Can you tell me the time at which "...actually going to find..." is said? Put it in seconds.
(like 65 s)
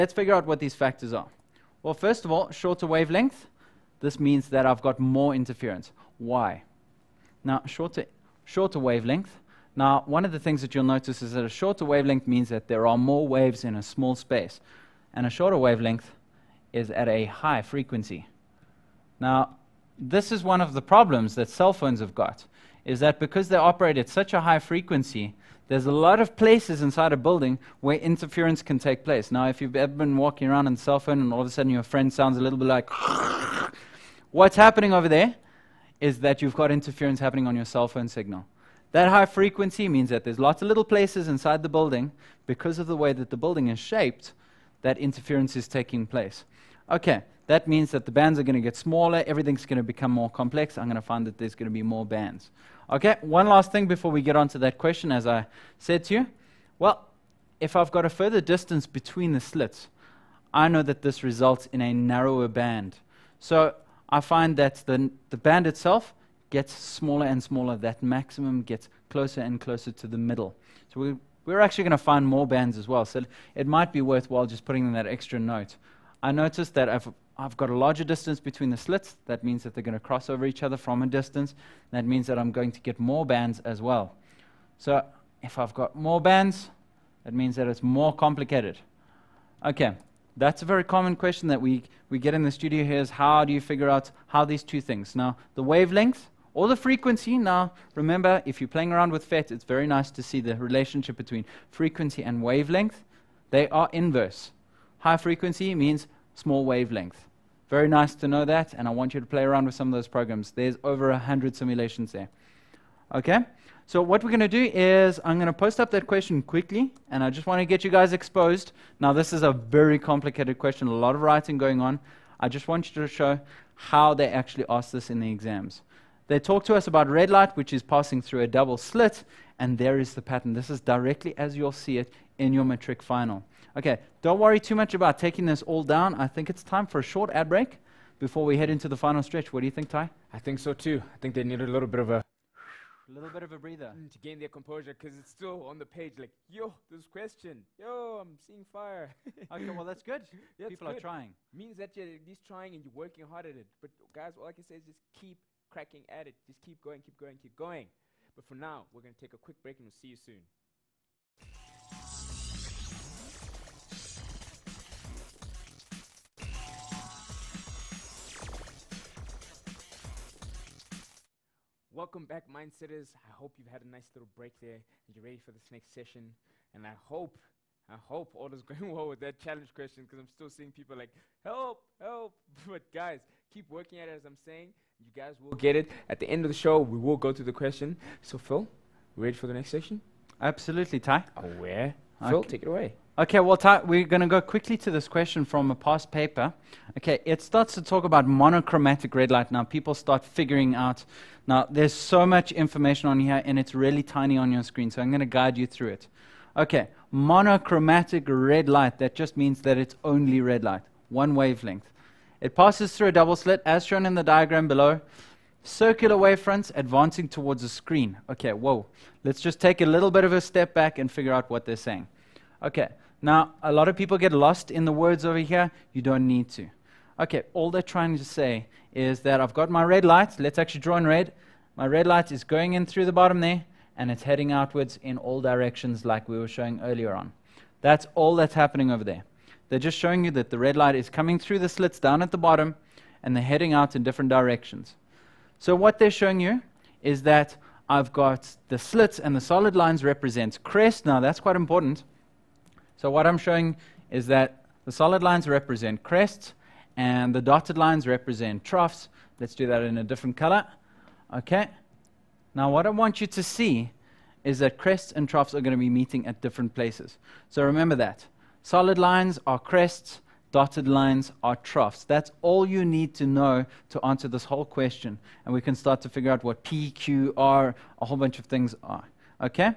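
71 s.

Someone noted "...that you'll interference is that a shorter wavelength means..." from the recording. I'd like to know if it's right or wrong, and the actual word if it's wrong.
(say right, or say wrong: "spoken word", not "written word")
wrong: "notice", not "interference".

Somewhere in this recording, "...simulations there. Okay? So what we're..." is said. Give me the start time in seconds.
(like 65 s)
111 s.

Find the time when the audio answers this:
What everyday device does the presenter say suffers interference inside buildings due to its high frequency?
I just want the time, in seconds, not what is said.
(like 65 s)
21 s.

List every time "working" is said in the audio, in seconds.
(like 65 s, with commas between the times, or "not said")
152 s, 183 s.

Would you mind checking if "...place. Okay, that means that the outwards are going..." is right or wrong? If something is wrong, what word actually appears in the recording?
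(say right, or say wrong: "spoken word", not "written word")
wrong: "bands", not "outwards".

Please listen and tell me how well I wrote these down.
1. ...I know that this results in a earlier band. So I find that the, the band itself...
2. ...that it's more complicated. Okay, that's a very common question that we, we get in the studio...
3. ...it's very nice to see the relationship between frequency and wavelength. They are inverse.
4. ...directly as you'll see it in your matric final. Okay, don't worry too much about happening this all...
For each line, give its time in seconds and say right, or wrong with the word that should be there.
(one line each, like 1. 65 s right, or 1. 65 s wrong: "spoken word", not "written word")
1. 60 s wrong: "narrower", not "earlier"
2. 87 s right
3. 99 s right
4. 130 s wrong: "taking", not "happening".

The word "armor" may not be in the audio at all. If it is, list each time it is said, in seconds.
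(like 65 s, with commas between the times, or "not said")
not said.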